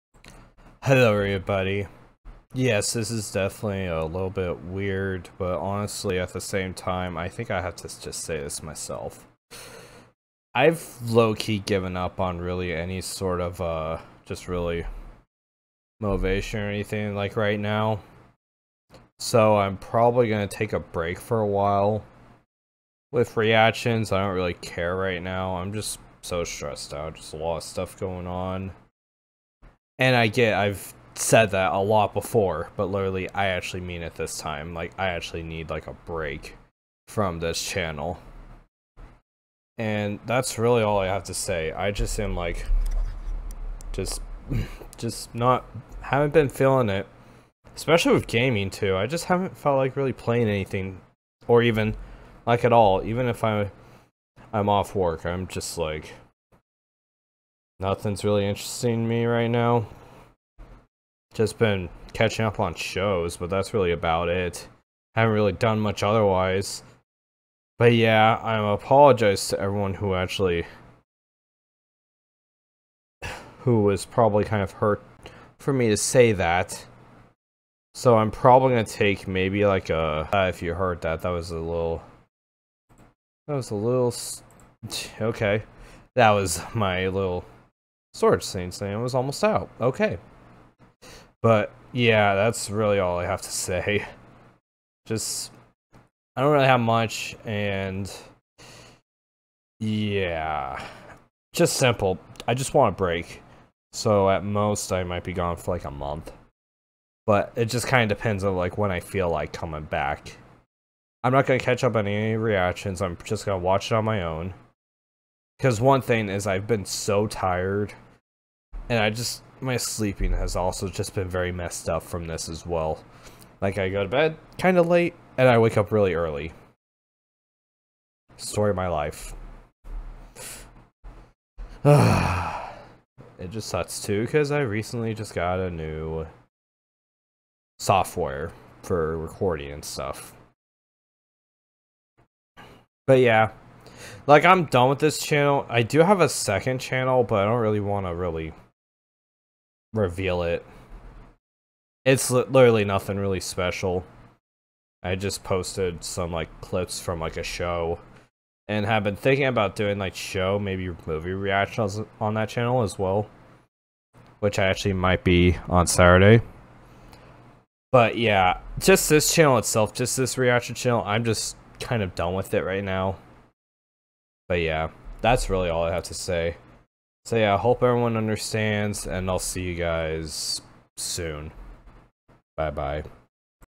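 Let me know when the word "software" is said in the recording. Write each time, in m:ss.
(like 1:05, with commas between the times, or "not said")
2:17.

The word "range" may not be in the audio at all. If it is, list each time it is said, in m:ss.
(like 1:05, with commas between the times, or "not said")
not said.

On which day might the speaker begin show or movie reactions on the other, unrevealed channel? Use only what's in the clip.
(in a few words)
Saturday.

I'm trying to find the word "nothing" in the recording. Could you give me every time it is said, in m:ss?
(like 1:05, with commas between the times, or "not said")
0:57, 2:32.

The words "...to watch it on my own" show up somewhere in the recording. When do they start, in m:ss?
1:53.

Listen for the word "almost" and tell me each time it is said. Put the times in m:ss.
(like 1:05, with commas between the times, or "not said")
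1:29.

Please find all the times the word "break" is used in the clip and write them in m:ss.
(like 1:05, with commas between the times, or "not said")
0:20, 0:35, 1:42.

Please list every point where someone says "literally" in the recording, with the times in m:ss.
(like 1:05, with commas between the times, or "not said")
0:32, 2:32.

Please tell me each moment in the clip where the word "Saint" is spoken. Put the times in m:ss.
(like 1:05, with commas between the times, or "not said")
1:28.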